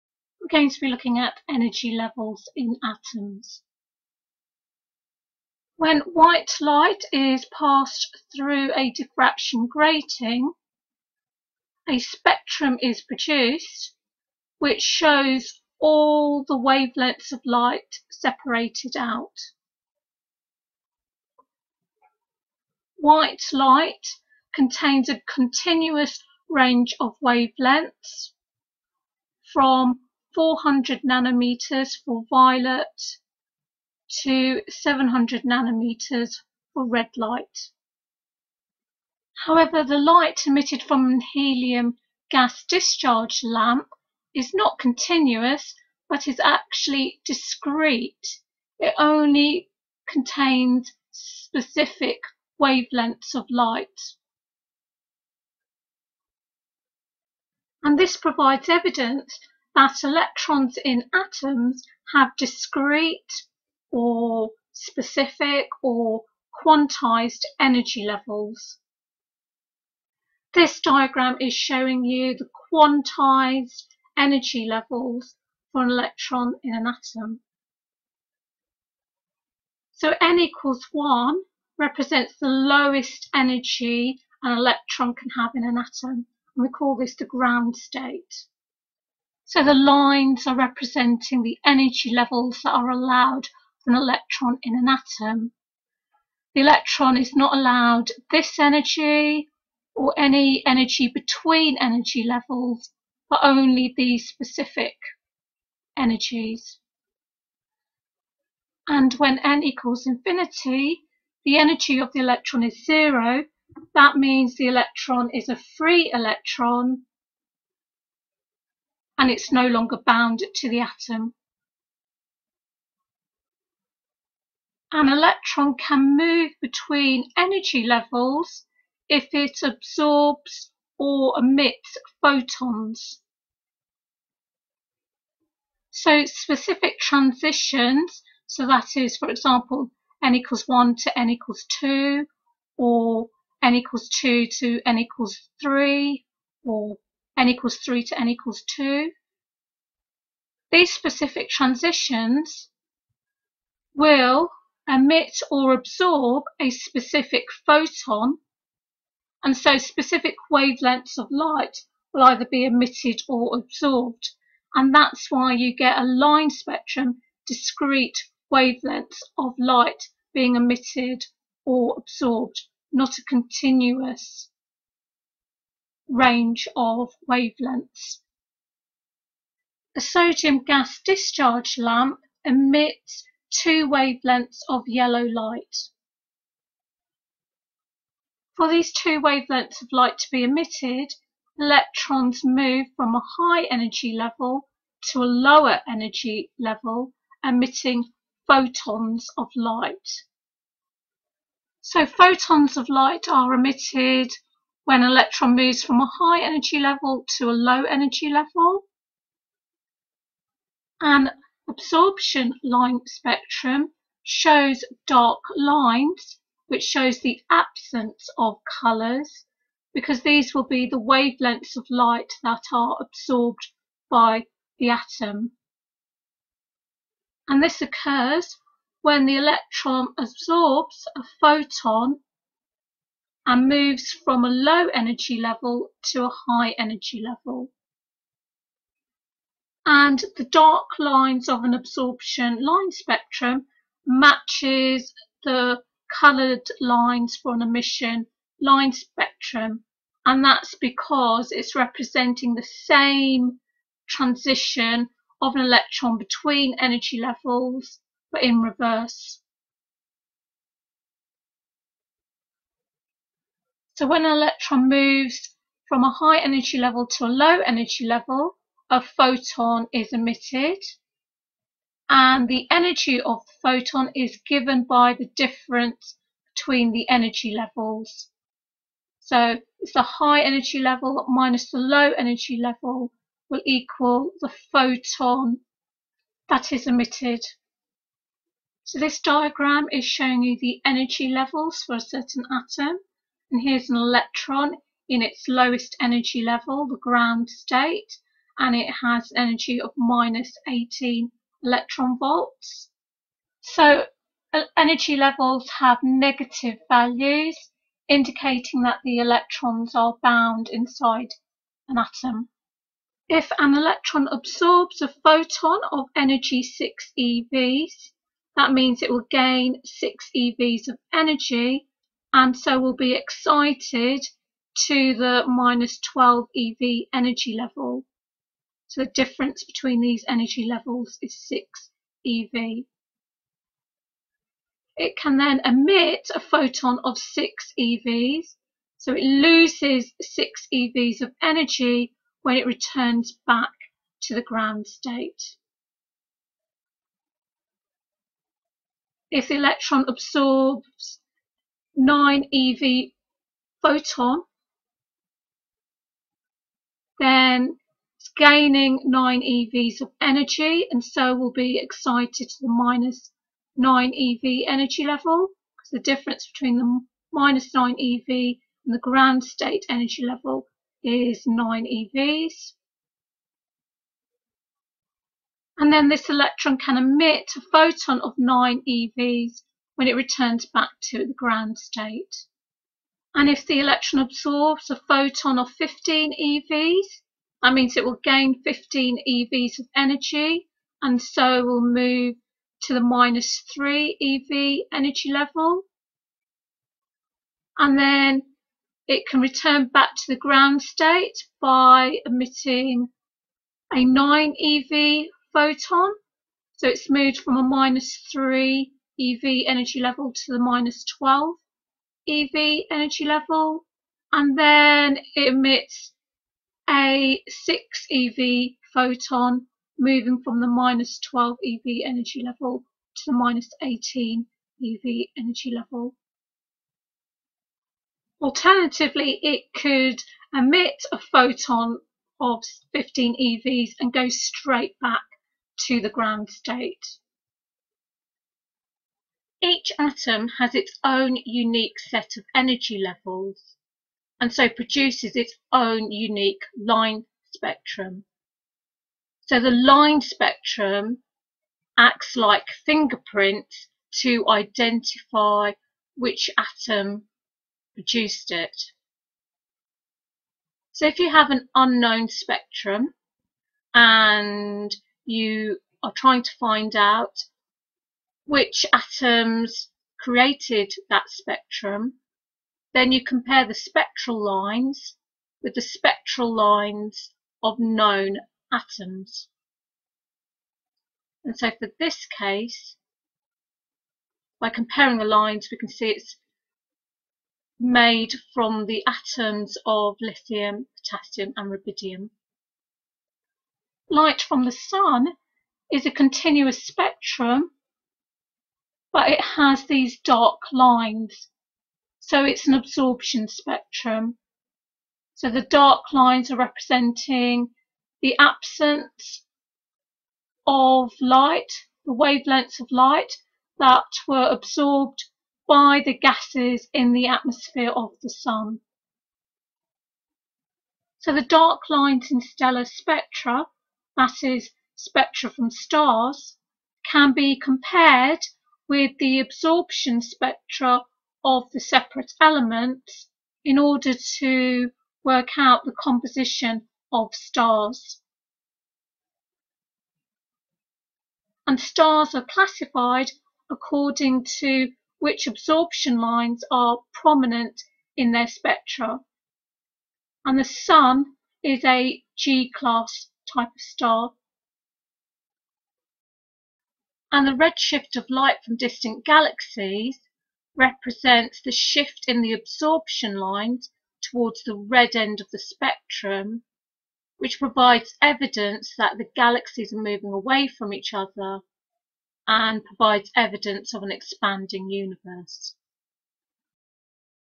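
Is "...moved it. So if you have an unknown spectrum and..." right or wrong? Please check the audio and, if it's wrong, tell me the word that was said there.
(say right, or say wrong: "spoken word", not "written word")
wrong: "produced", not "moved".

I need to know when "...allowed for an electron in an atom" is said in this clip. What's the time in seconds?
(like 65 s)
92 s.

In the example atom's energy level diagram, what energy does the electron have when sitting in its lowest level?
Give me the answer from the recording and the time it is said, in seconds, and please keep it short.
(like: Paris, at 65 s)
-18 eV, at 299 s.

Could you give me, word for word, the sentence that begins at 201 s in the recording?
So photons of light are emitted when an electron moves from a high energy level to a low energy level.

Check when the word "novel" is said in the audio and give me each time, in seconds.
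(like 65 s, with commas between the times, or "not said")
not said.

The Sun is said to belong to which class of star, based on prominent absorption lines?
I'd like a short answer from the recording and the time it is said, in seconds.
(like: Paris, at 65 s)
G-class, at 552 s.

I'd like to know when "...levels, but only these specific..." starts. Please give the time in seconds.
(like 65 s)
102 s.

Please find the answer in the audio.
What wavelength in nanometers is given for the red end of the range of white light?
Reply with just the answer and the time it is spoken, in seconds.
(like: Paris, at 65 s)
700 nanometers, at 34 s.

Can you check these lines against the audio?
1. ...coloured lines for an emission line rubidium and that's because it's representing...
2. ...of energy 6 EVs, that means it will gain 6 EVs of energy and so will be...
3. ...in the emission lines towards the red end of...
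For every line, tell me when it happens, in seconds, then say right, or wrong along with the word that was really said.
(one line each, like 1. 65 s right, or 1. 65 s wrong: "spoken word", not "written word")
1. 246 s wrong: "spectrum", not "rubidium"
2. 315 s right
3. 562 s wrong: "absorption", not "emission".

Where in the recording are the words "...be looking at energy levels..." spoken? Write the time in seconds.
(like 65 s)
0 s.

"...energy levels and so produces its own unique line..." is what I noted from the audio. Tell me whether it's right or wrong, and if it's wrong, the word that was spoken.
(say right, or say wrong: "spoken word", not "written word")
right.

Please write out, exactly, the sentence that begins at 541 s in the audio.
And stars are classified according to which absorption lines are prominent in their spectra.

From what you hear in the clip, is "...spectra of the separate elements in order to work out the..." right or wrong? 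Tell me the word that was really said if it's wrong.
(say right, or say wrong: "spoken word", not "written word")
right.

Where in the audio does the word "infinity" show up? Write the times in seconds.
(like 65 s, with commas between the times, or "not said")
110 s.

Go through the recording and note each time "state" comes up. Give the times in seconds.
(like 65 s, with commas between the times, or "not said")
87 s, 297 s, 344 s, 369 s, 381 s, 400 s, 436 s.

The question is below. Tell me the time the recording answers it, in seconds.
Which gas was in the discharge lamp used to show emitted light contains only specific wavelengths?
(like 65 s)
41 s.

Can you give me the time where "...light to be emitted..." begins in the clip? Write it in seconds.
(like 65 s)
189 s.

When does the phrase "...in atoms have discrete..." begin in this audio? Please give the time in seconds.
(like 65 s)
60 s.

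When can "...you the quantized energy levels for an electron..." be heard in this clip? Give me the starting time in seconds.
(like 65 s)
72 s.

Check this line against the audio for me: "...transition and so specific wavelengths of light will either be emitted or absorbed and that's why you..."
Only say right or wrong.
wrong.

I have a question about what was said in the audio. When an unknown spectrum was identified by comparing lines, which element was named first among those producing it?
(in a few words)
Lithium.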